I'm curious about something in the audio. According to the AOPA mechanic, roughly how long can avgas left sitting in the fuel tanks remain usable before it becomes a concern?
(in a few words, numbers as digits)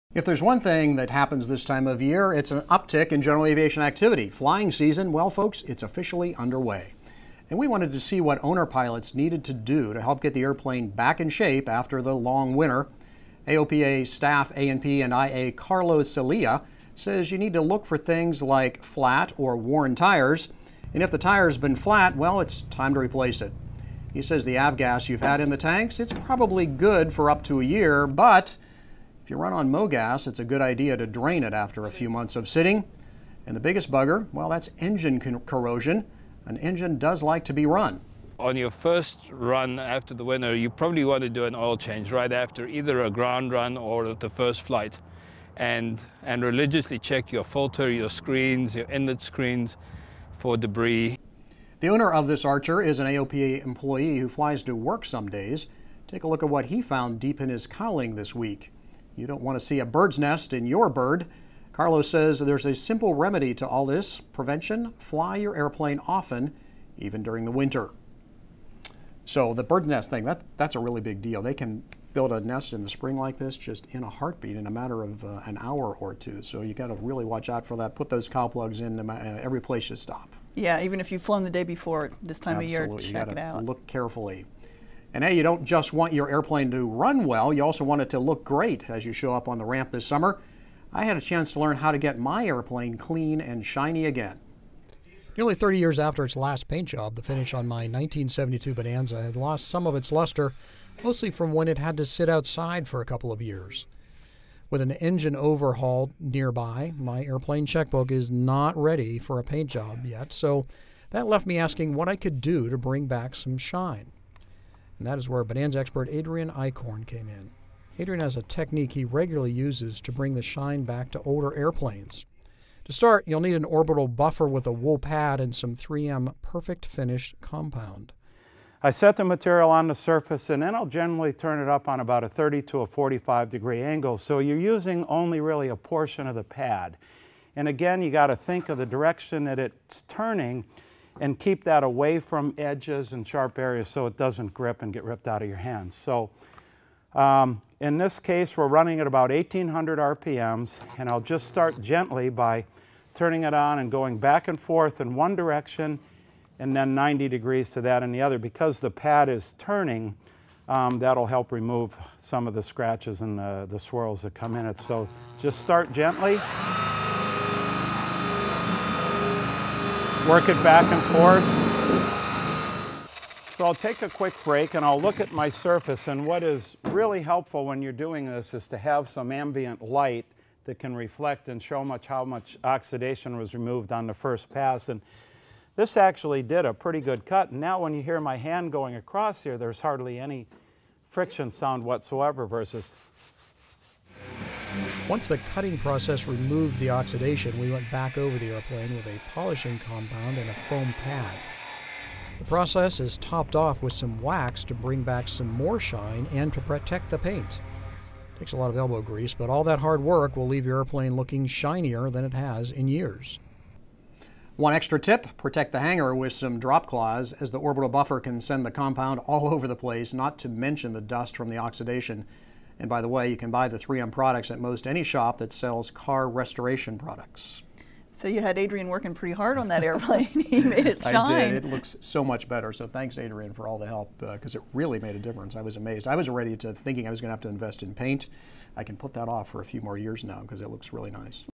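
up to a year.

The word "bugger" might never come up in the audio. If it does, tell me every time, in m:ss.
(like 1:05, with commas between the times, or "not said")
0:33.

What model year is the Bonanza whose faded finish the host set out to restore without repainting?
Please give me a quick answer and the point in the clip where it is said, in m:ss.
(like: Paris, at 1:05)
1972, at 1:37.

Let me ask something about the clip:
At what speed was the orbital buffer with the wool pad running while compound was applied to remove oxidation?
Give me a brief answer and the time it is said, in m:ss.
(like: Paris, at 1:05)
1800 RPM, at 2:29.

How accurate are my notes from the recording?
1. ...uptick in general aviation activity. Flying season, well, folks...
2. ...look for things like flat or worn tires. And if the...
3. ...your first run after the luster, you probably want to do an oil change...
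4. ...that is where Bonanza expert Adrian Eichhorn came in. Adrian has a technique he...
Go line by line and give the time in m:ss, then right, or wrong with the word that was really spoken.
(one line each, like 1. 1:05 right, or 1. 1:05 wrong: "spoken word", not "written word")
1. 0:02 right
2. 0:17 right
3. 0:38 wrong: "winter", not "luster"
4. 1:55 right.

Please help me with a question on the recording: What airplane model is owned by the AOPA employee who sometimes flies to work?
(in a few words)
Archer.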